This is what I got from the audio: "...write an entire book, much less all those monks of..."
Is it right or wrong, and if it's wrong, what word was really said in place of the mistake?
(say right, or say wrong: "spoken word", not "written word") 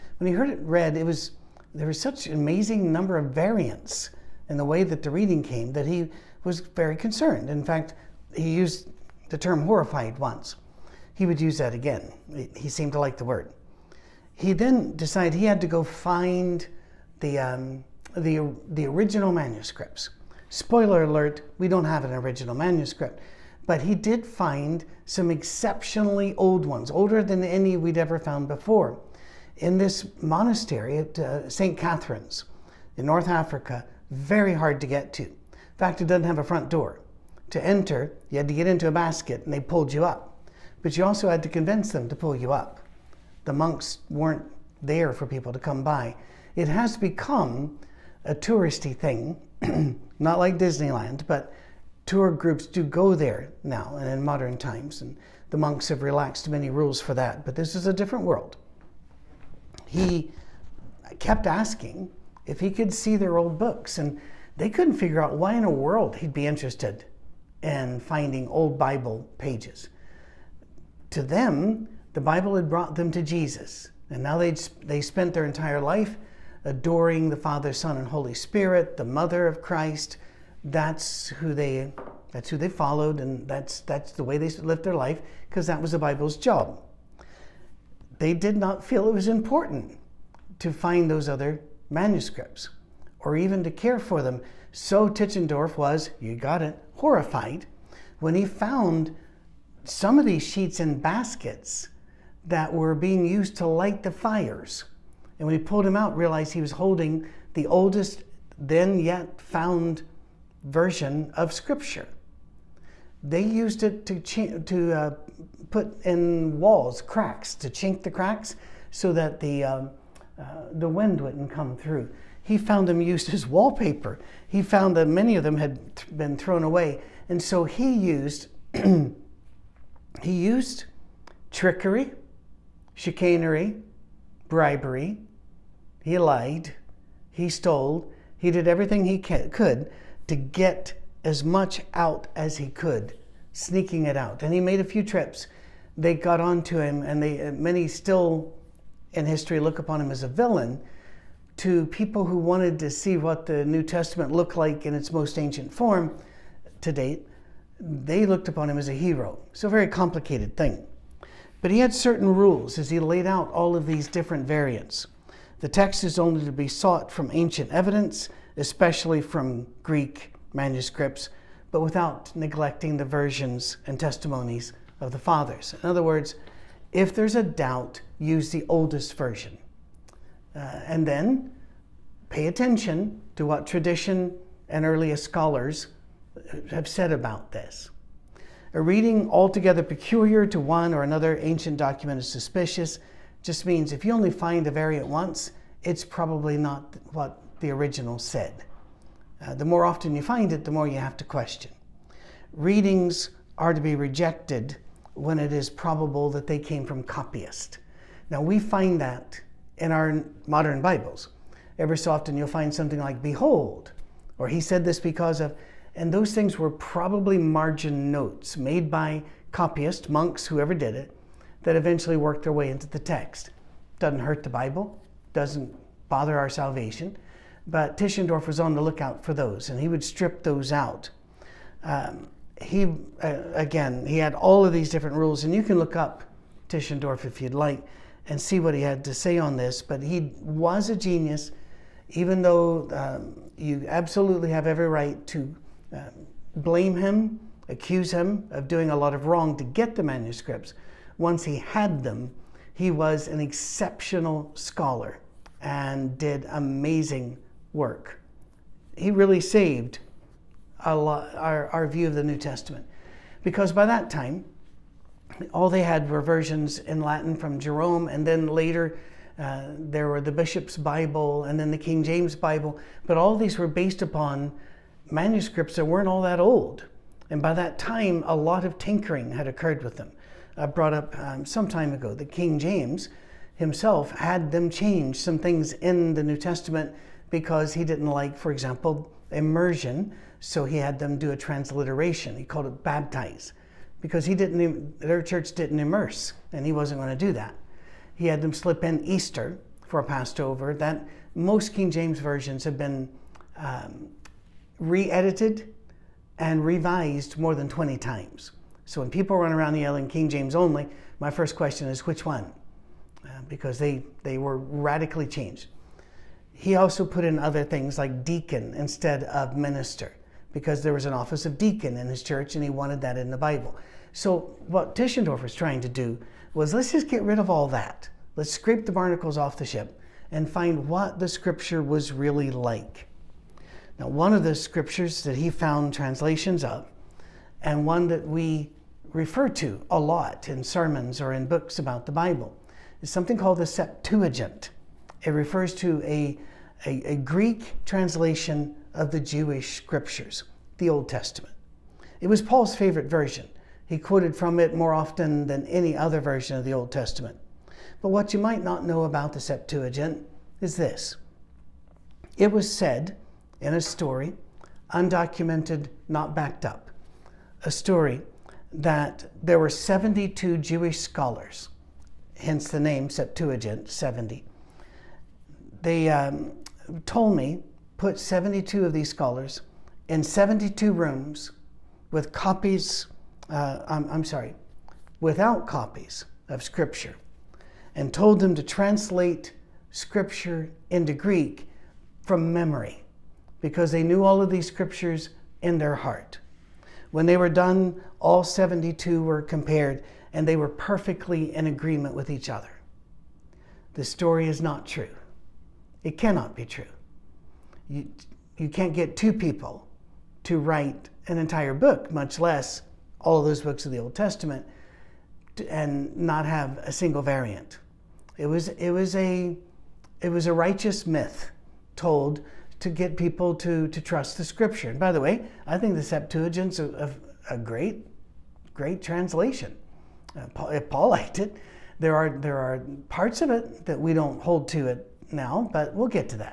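wrong: "books", not "monks".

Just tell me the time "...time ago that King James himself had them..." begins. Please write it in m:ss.
4:41.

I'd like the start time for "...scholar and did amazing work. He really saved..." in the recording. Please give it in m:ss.
4:14.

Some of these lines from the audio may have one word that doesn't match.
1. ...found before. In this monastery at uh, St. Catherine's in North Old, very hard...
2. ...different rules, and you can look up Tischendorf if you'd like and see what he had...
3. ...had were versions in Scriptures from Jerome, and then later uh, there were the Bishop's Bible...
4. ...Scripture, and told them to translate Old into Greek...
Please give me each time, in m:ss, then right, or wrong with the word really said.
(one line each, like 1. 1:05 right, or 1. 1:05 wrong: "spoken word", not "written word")
1. 0:28 wrong: "Africa", not "Old"
2. 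3:54 right
3. 4:25 wrong: "Latin", not "Scriptures"
4. 6:26 wrong: "Scripture", not "Old".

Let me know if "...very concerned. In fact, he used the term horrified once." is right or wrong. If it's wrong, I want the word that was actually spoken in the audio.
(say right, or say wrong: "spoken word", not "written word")
right.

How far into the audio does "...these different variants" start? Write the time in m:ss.
2:43.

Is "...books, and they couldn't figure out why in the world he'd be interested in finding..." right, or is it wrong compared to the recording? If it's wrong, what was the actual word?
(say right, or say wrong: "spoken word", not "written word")
right.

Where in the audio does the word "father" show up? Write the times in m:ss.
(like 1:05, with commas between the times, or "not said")
1:17, 2:55.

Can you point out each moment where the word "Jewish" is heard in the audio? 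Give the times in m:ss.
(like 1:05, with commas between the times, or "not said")
5:49, 6:10.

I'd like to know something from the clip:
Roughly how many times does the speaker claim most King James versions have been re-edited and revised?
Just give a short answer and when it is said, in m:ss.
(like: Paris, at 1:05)
More than 20, at 5:07.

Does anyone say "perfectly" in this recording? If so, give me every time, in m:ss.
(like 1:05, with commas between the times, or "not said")
6:40.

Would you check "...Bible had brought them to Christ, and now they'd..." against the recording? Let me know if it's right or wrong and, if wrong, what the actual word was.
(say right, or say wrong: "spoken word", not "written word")
wrong: "Jesus", not "Christ".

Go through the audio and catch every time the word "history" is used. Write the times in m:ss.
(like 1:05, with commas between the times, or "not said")
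2:29.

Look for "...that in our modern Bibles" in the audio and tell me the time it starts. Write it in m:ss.
3:29.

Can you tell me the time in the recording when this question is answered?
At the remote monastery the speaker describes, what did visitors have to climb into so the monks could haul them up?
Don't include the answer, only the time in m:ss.
0:38.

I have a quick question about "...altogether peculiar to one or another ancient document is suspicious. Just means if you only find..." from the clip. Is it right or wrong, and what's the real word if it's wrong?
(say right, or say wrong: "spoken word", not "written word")
right.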